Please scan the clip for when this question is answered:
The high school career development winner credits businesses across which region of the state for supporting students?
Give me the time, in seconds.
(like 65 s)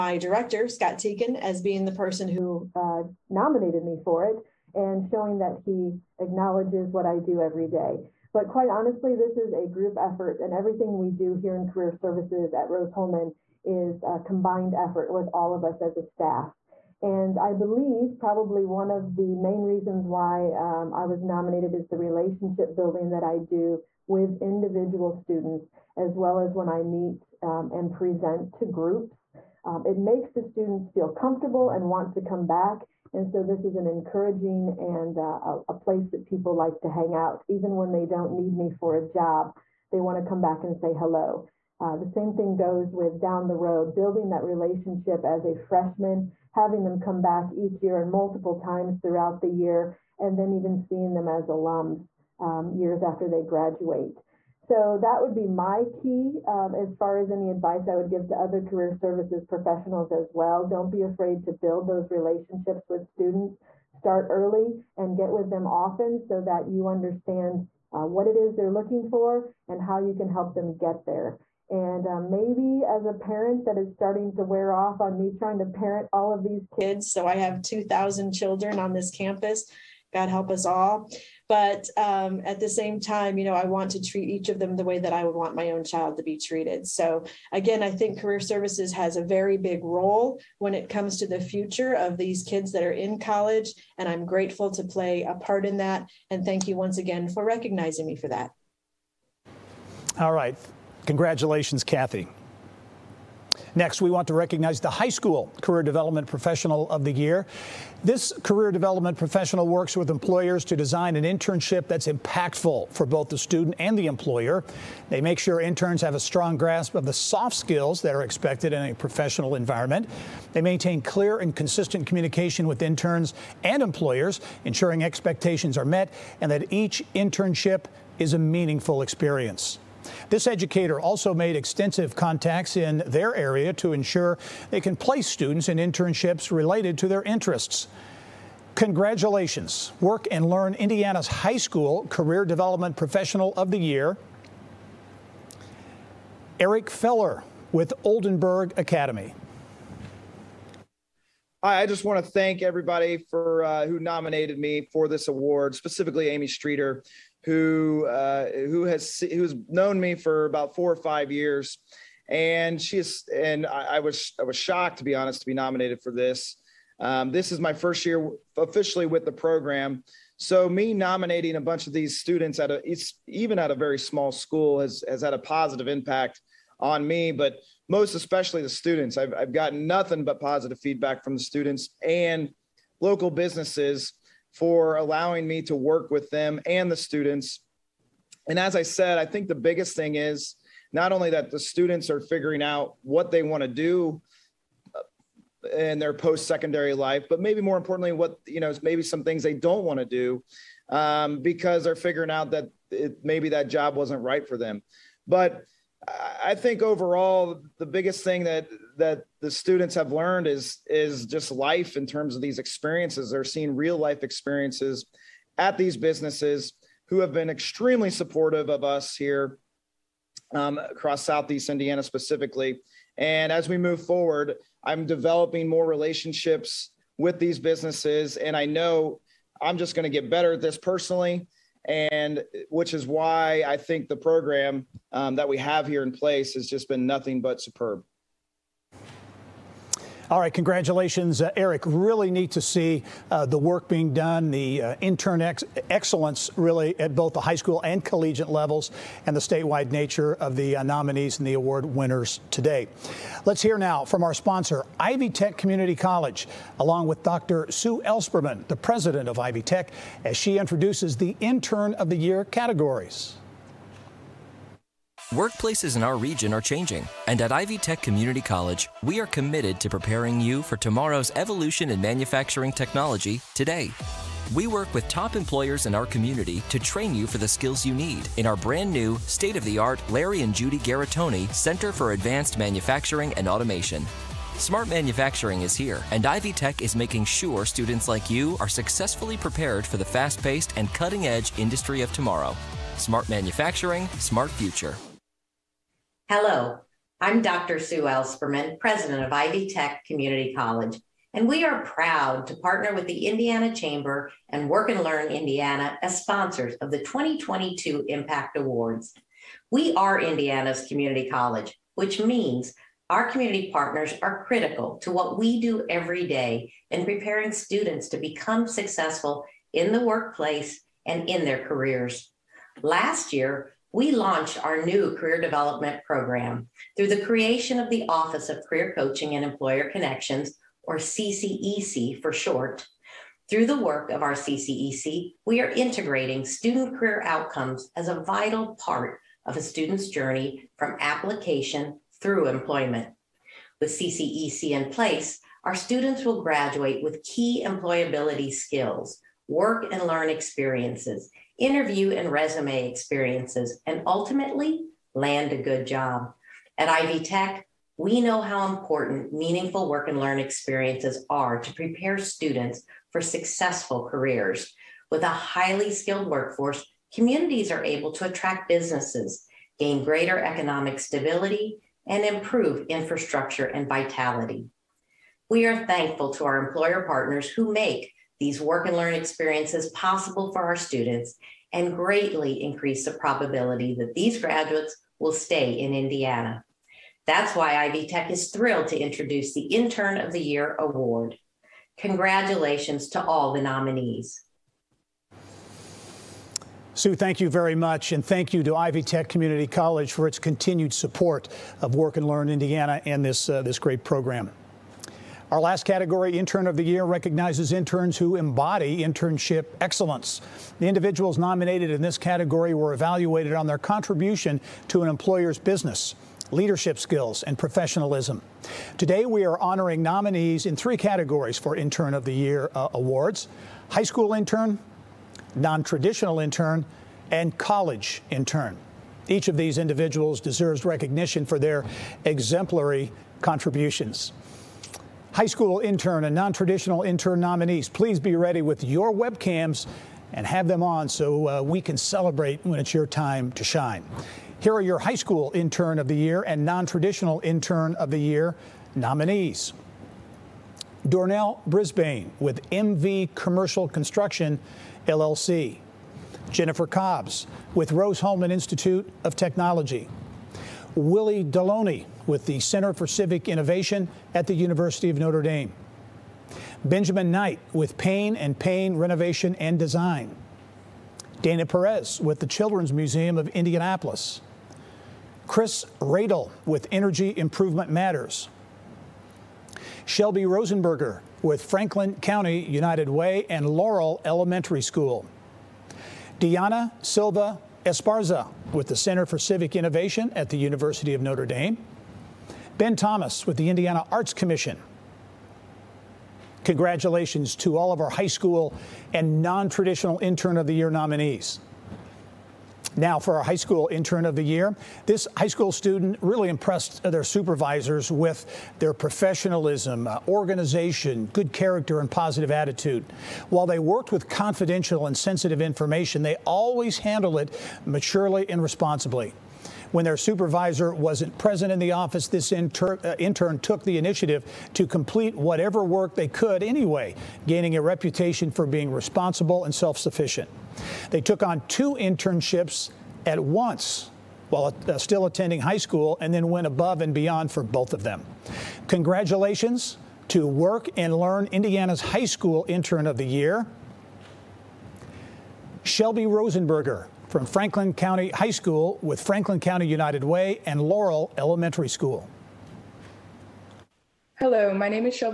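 221 s.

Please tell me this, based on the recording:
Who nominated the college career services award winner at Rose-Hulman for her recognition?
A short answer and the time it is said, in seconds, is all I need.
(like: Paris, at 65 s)
Scott Teakin, at 0 s.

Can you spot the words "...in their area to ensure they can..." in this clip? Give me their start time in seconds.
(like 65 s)
132 s.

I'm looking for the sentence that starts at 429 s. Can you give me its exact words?
Each of these individuals deserves recognition for their exemplary contributions high school intern and non-traditional intern nominees.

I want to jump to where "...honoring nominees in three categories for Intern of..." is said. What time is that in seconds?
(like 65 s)
419 s.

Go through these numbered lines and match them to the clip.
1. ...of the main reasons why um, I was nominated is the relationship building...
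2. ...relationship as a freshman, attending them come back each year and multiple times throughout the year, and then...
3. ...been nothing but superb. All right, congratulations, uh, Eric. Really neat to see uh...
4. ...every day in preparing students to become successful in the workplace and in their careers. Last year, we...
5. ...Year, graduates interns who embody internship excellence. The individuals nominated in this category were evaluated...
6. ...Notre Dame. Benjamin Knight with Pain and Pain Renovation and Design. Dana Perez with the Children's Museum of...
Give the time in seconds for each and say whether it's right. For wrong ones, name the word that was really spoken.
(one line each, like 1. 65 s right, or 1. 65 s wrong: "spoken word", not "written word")
1. 18 s right
2. 44 s wrong: "having", not "attending"
3. 236 s right
4. 315 s right
5. 406 s wrong: "recognizes", not "graduates"
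6. 465 s right.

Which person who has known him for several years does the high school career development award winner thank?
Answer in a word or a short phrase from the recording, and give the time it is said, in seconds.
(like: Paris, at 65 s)
Amy Streeter, at 156 s.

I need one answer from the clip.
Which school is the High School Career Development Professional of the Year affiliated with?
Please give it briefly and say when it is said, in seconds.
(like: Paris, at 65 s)
Oldenburg Academy, at 148 s.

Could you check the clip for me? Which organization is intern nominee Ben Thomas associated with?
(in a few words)
Indiana Arts Commission.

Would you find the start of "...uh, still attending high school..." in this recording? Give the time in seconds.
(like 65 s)
534 s.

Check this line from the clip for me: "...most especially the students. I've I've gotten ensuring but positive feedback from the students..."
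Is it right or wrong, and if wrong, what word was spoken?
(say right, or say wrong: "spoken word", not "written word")
wrong: "nothing", not "ensuring".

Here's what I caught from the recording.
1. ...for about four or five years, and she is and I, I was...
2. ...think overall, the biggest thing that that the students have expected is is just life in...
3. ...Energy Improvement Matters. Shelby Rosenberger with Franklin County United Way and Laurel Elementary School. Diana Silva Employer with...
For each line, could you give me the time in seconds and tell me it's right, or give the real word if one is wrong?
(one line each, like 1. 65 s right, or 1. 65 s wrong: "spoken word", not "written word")
1. 160 s right
2. 206 s wrong: "learned", not "expected"
3. 476 s wrong: "Esparza", not "Employer".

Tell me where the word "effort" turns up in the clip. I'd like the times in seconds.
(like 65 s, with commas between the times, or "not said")
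9 s, 14 s.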